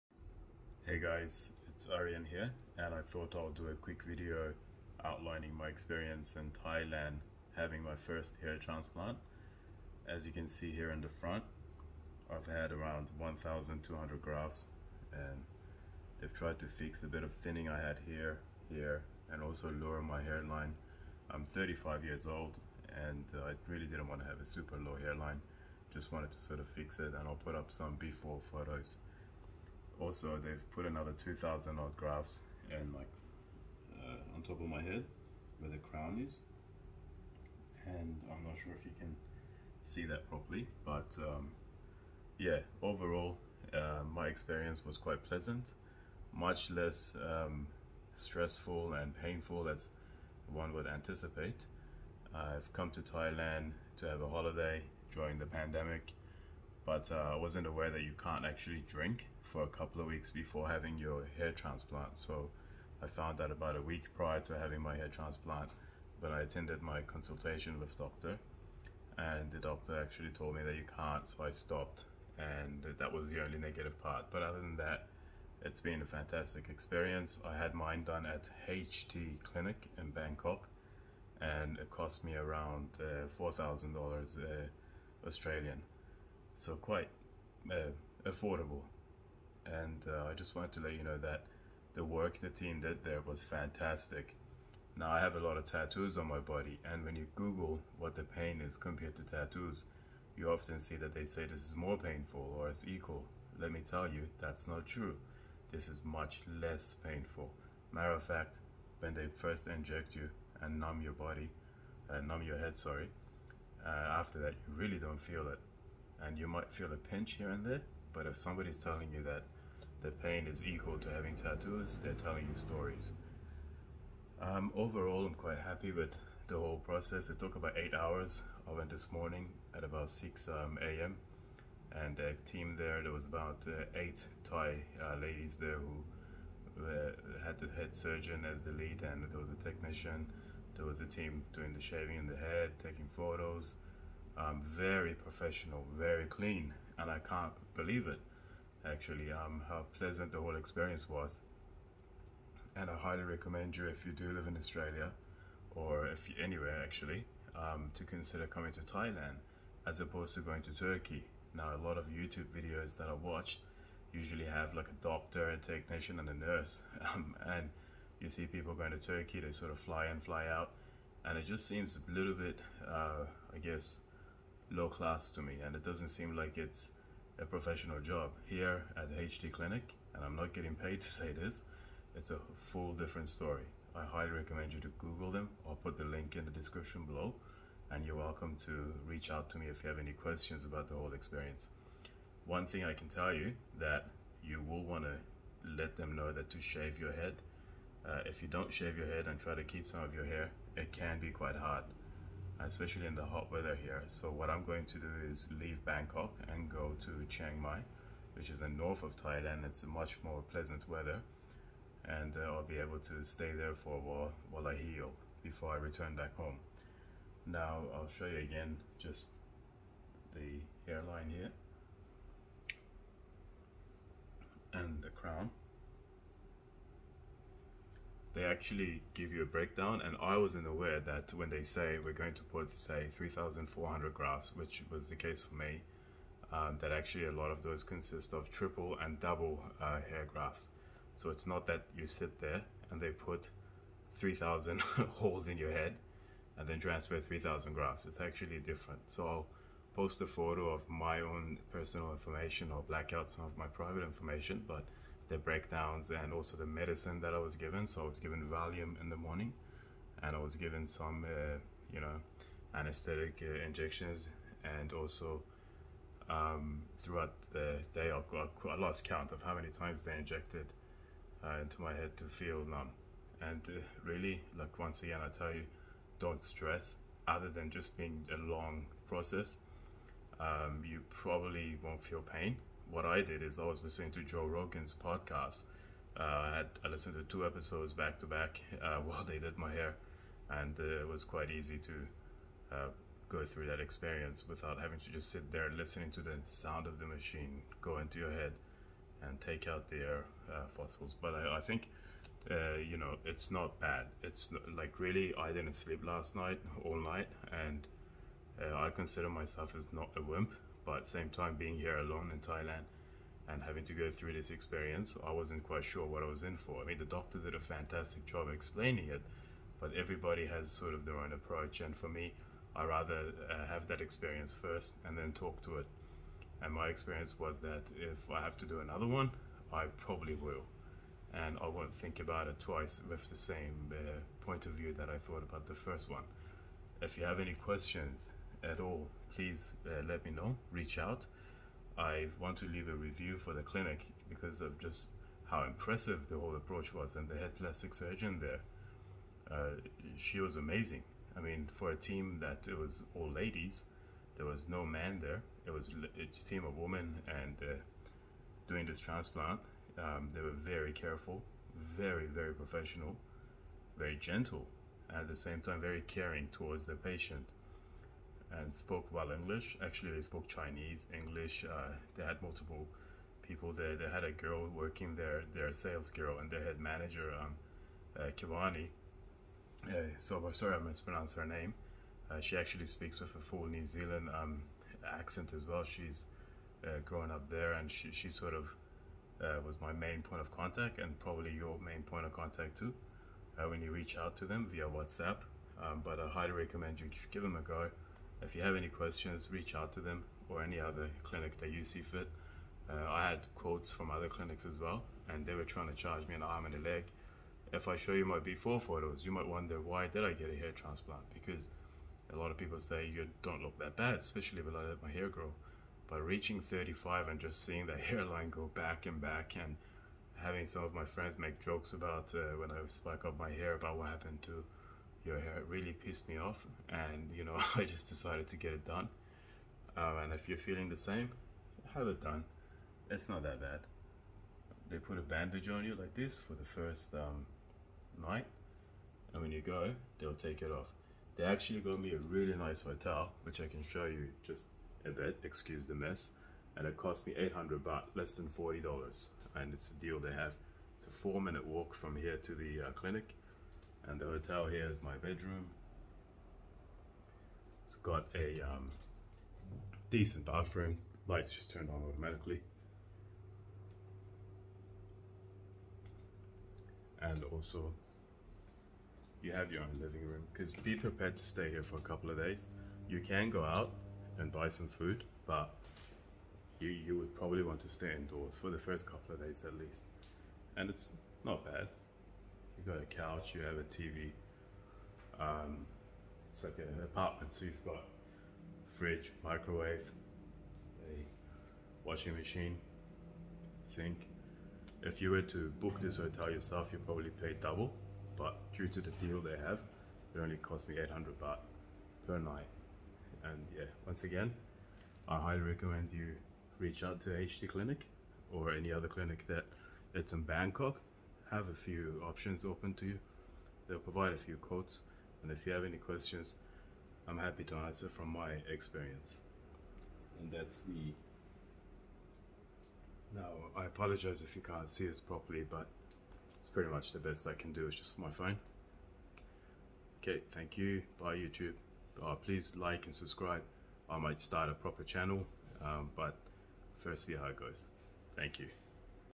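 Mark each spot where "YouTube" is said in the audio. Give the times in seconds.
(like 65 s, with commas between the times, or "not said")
162 s, 531 s.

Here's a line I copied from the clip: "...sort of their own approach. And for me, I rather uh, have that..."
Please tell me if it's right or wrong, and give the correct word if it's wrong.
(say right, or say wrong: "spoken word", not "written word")
right.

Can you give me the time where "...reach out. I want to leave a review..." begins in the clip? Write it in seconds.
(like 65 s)
340 s.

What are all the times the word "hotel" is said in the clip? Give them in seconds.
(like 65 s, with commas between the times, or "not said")
442 s, 454 s, 496 s.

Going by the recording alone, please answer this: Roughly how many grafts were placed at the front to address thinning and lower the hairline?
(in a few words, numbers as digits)
1,200.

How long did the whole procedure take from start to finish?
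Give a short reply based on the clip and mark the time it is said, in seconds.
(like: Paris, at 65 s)
Eight hours, at 127 s.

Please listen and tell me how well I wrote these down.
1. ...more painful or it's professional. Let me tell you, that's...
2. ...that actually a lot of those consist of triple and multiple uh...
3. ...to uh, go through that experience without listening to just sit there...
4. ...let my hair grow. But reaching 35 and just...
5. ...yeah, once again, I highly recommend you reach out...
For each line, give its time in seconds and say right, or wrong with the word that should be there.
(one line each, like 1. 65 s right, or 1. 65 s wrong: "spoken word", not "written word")
1. 101 s wrong: "equal", not "professional"
2. 236 s wrong: "double", not "multiple"
3. 291 s wrong: "having", not "listening"
4. 414 s right
5. 503 s right.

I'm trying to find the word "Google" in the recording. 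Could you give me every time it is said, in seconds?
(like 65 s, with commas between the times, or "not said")
97 s, 184 s.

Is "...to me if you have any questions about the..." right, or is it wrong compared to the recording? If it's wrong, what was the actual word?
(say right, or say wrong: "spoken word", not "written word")
right.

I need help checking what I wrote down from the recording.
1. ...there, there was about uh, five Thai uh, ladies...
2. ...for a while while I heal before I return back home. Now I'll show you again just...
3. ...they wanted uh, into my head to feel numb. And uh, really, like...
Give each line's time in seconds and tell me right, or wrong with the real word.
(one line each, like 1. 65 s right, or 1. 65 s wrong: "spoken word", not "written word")
1. 132 s wrong: "eight", not "five"
2. 213 s right
3. 270 s wrong: "injected", not "wanted".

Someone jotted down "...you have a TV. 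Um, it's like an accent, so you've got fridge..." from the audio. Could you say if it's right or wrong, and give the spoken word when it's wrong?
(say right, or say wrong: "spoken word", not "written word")
wrong: "apartment", not "accent".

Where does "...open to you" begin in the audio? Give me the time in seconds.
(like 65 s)
512 s.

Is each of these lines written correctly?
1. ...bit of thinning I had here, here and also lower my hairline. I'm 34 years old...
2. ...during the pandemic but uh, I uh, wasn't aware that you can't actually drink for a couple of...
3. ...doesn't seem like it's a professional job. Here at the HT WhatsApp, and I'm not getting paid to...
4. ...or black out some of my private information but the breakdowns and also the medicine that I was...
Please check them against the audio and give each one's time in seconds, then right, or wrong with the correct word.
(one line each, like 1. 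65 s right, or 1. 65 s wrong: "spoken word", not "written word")
1. 17 s wrong: "35", not "34"
2. 55 s right
3. 175 s wrong: "Clinic", not "WhatsApp"
4. 252 s right.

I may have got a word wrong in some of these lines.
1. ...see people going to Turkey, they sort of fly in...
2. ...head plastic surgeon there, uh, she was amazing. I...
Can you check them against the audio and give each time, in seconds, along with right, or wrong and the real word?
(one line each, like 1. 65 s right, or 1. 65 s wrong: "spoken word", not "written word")
1. 168 s right
2. 347 s right.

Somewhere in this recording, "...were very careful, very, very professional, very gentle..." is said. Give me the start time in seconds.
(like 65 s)
360 s.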